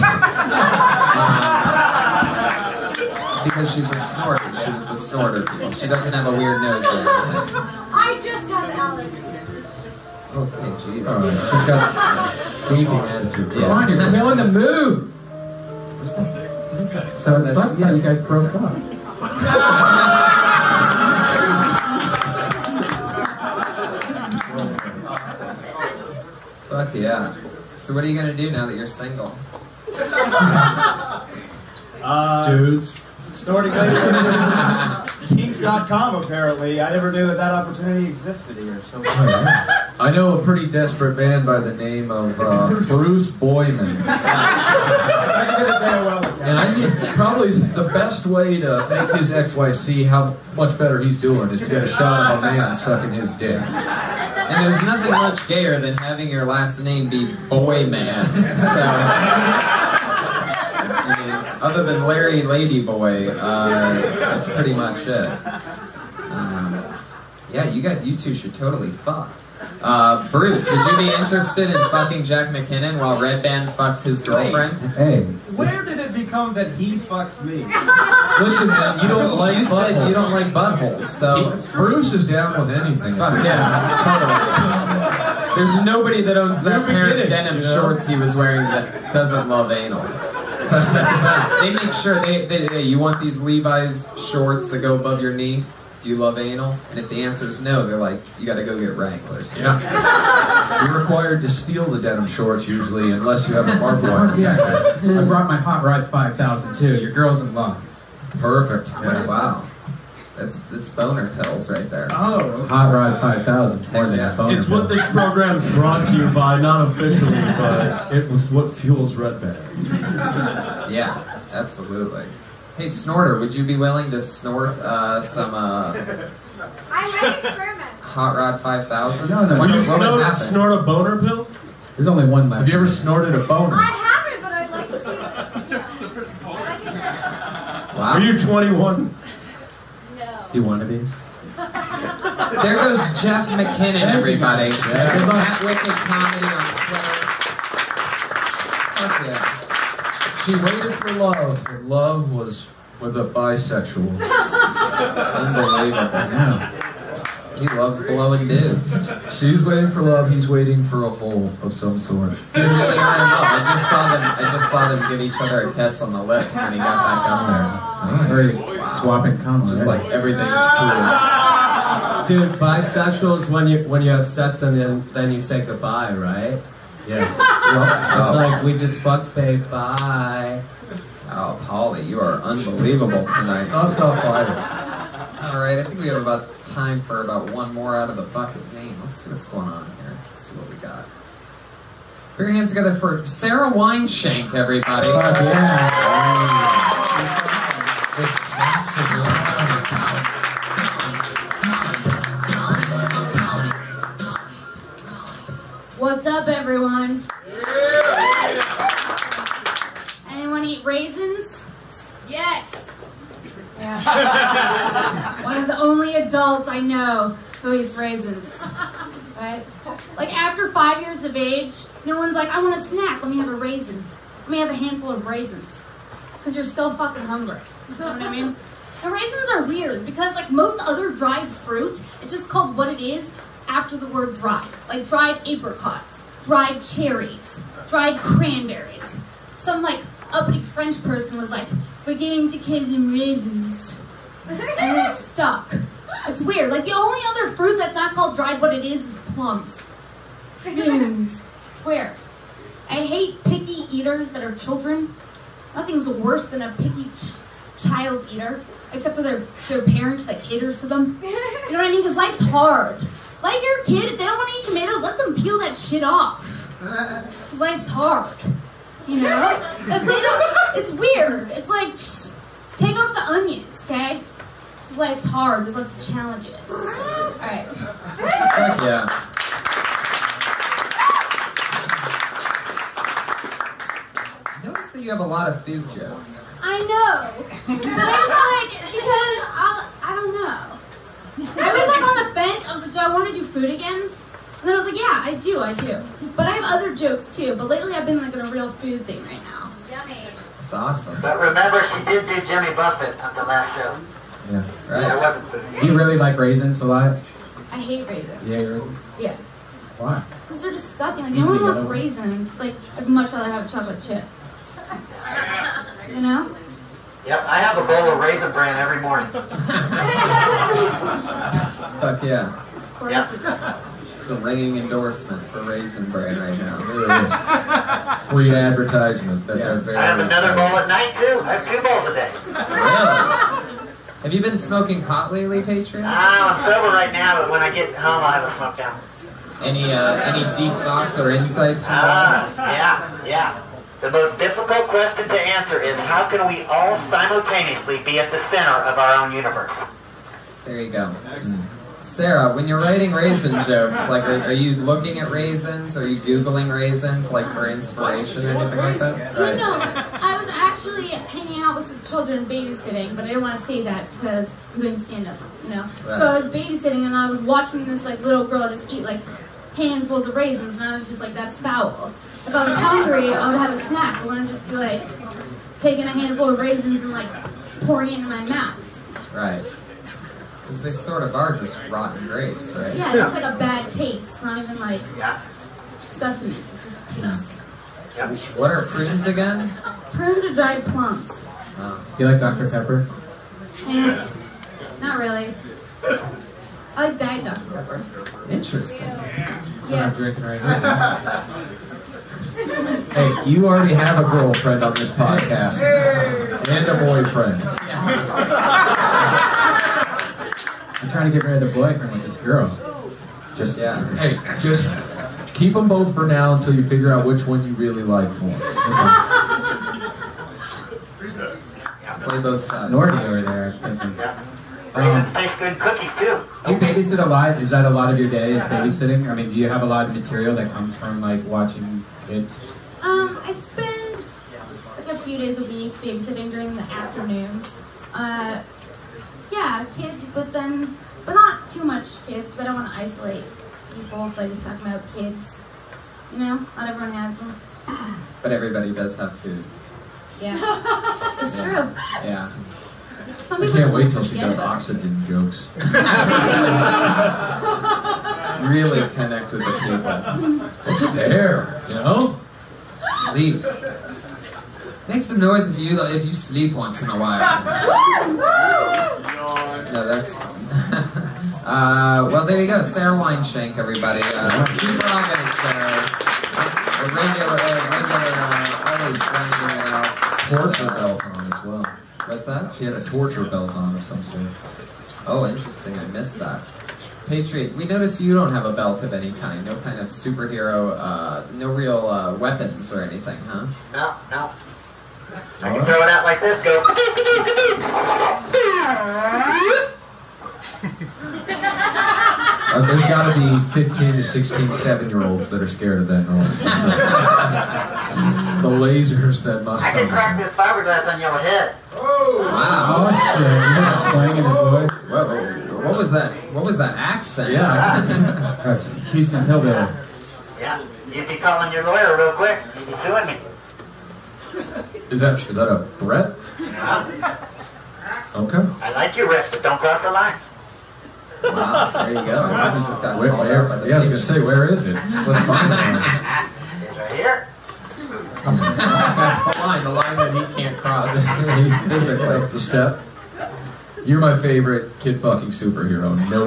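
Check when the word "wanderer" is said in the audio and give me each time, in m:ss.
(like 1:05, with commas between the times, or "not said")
not said.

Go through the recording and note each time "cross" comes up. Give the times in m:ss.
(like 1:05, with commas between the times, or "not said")
8:49, 9:00.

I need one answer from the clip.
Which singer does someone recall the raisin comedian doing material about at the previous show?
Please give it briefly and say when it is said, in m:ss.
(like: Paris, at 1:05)
Jimmy Buffett, at 5:02.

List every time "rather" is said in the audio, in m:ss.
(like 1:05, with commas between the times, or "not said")
5:13.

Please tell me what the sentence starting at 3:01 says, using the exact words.
Oh, Pauly, you are unbelievable tonight.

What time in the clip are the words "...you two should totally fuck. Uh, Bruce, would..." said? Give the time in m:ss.
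1:08.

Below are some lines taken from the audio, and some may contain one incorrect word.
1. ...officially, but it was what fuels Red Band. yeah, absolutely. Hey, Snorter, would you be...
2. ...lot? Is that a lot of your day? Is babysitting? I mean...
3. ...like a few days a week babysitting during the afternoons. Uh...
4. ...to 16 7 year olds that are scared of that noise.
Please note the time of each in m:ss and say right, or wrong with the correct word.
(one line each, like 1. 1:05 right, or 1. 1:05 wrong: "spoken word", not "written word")
1. 1:56 right
2. 7:07 right
3. 7:14 right
4. 8:24 right.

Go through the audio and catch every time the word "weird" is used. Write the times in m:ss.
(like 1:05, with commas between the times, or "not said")
0:06, 3:49, 4:06, 4:11, 4:30.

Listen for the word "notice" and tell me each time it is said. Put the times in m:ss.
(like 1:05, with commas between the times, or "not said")
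4:44, 8:07.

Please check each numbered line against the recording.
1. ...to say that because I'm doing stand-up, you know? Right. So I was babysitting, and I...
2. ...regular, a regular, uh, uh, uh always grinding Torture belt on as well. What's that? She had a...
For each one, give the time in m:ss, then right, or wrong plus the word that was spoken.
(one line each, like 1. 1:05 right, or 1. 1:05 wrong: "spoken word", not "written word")
1. 6:03 right
2. 7:57 right.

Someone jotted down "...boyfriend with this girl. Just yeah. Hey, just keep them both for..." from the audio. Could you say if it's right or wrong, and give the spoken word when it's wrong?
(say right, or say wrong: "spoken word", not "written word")
right.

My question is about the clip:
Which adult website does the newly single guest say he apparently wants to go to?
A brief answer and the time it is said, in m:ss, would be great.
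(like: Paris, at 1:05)
Kink.com, at 0:35.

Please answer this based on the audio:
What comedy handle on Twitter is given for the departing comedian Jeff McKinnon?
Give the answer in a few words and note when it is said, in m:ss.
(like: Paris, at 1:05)
Wicked Comedy, at 2:25.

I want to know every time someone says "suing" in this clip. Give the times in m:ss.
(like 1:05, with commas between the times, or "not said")
8:42.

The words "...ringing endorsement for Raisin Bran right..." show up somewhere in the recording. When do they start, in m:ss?
5:24.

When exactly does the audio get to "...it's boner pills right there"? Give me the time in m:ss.
1:50.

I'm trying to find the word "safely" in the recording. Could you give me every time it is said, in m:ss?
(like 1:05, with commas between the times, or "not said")
not said.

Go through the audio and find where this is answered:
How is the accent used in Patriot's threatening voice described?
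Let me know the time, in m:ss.
8:39.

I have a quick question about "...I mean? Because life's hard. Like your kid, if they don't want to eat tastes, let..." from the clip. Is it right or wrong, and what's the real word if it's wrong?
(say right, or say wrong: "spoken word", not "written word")
wrong: "tomatoes", not "tastes".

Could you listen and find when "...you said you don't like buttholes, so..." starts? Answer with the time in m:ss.
1:19.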